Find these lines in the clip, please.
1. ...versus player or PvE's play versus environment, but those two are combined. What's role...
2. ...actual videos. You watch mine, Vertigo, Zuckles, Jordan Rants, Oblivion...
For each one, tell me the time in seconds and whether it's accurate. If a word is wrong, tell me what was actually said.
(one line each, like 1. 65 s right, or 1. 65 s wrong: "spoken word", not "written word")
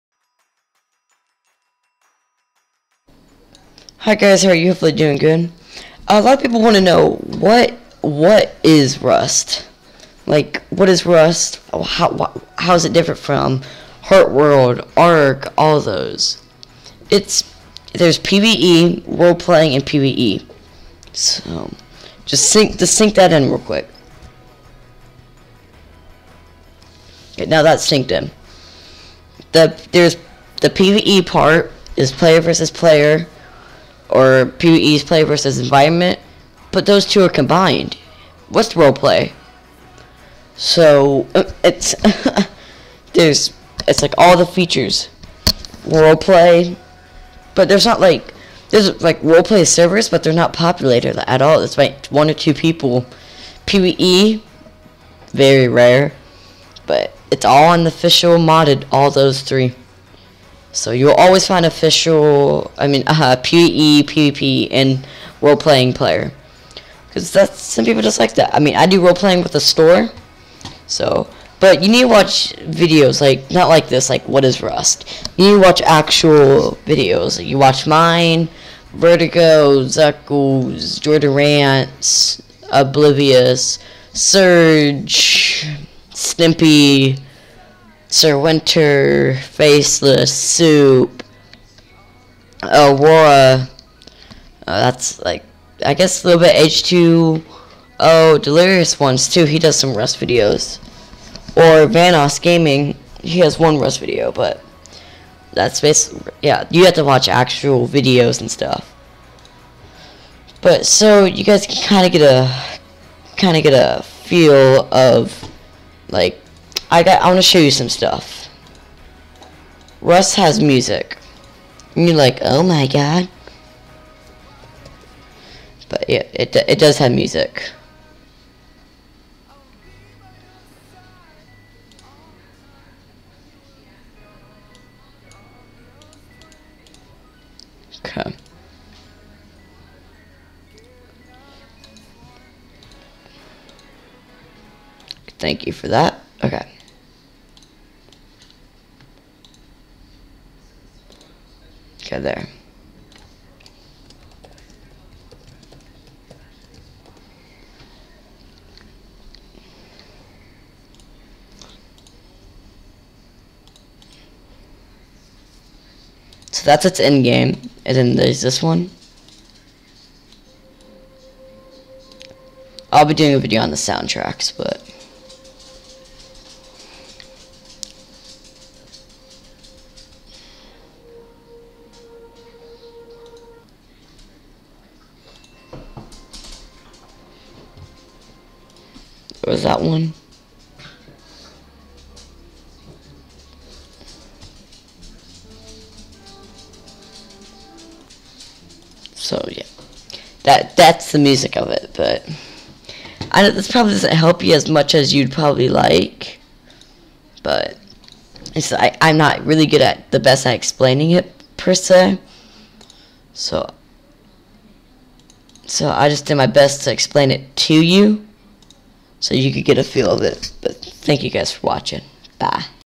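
1. 32 s right
2. 75 s right.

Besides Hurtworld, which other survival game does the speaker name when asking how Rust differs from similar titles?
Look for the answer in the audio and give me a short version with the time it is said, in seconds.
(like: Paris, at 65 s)
Ark, at 14 s.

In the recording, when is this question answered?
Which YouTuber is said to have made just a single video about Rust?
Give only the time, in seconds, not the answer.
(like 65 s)
101 s.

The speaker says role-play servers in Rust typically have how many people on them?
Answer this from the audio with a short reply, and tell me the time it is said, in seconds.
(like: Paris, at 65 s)
one or two, at 52 s.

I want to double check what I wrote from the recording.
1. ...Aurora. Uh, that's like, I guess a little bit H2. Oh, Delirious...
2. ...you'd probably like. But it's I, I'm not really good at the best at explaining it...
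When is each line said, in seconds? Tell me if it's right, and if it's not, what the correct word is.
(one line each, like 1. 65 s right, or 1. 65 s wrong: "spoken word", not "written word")
1. 92 s right
2. 205 s right.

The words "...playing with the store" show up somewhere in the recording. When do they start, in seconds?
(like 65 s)
69 s.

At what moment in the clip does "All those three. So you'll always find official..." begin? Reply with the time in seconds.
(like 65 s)
58 s.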